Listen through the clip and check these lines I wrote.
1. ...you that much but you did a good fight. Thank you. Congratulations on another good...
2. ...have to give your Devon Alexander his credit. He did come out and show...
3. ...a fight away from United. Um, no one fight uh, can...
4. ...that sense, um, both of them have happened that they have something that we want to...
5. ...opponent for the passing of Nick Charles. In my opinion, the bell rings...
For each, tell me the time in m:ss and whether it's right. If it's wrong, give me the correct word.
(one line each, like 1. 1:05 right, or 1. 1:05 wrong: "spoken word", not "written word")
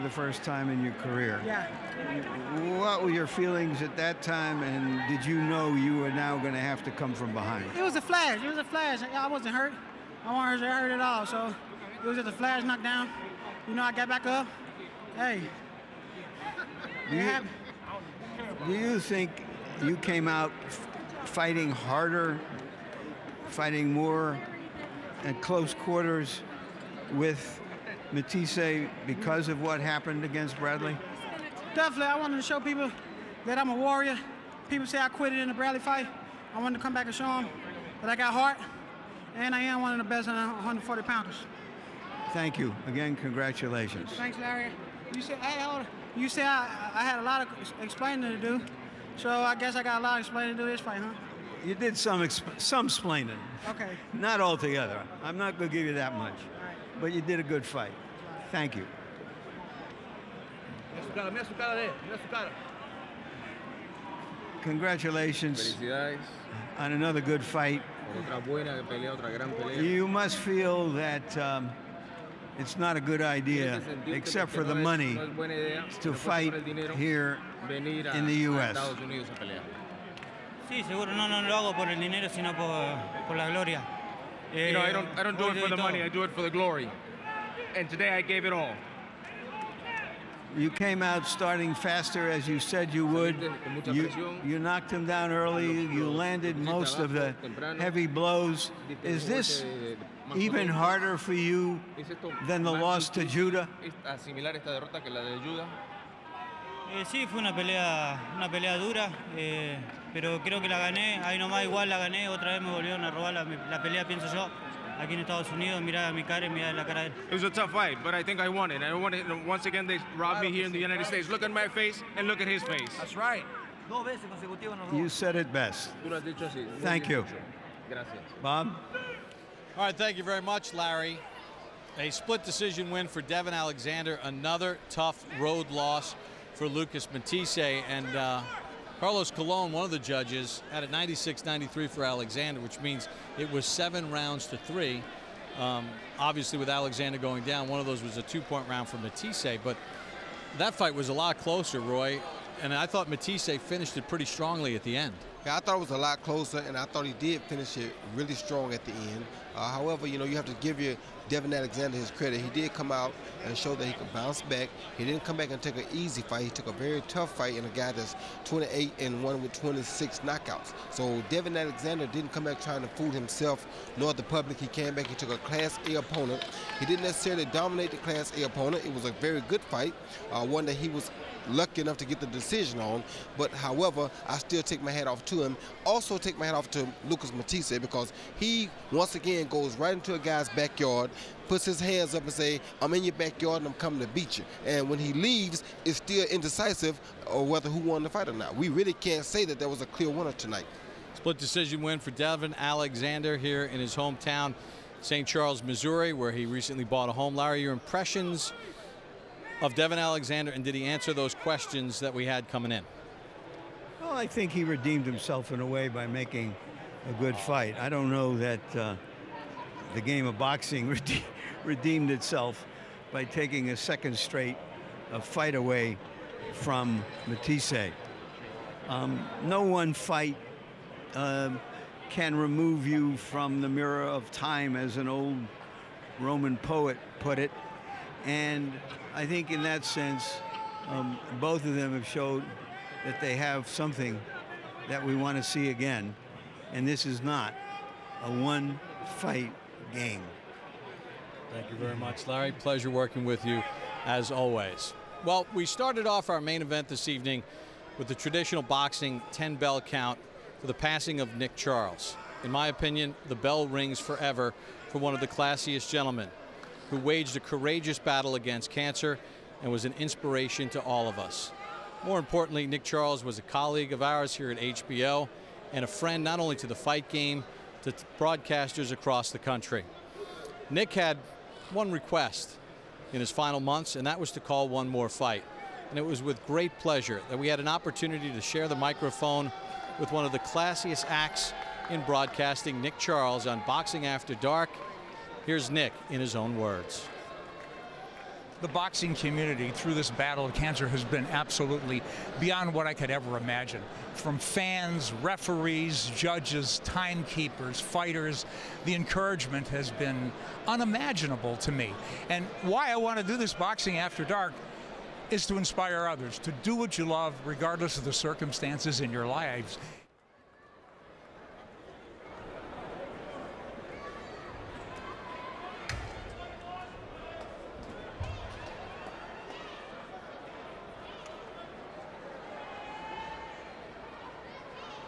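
1. 0:55 right
2. 2:40 right
3. 3:45 wrong: "Matthysse", not "United"
4. 3:59 wrong: "showed", not "happened"
5. 4:19 wrong: "count", not "opponent".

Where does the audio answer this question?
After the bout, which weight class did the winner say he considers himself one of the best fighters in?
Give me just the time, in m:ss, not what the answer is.
0:40.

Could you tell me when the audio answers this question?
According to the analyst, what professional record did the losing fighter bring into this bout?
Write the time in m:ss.
2:48.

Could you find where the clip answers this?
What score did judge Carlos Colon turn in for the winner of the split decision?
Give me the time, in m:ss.
2:20.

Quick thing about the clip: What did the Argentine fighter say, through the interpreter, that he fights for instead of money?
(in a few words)
glory.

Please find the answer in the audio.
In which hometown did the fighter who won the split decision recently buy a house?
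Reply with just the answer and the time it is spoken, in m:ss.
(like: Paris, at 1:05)
St. Charles, Missouri, at 3:25.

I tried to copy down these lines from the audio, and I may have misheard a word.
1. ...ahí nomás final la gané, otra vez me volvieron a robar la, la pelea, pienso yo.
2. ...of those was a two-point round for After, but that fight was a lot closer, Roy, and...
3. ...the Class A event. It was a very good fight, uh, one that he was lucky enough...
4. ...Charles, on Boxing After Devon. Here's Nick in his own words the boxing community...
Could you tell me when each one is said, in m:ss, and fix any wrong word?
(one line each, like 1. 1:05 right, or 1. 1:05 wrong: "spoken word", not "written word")
1. 1:51 wrong: "igual", not "final"
2. 2:27 wrong: "Matthysse", not "After"
3. 2:57 wrong: "opponent", not "event"
4. 4:52 wrong: "Dark", not "Devon".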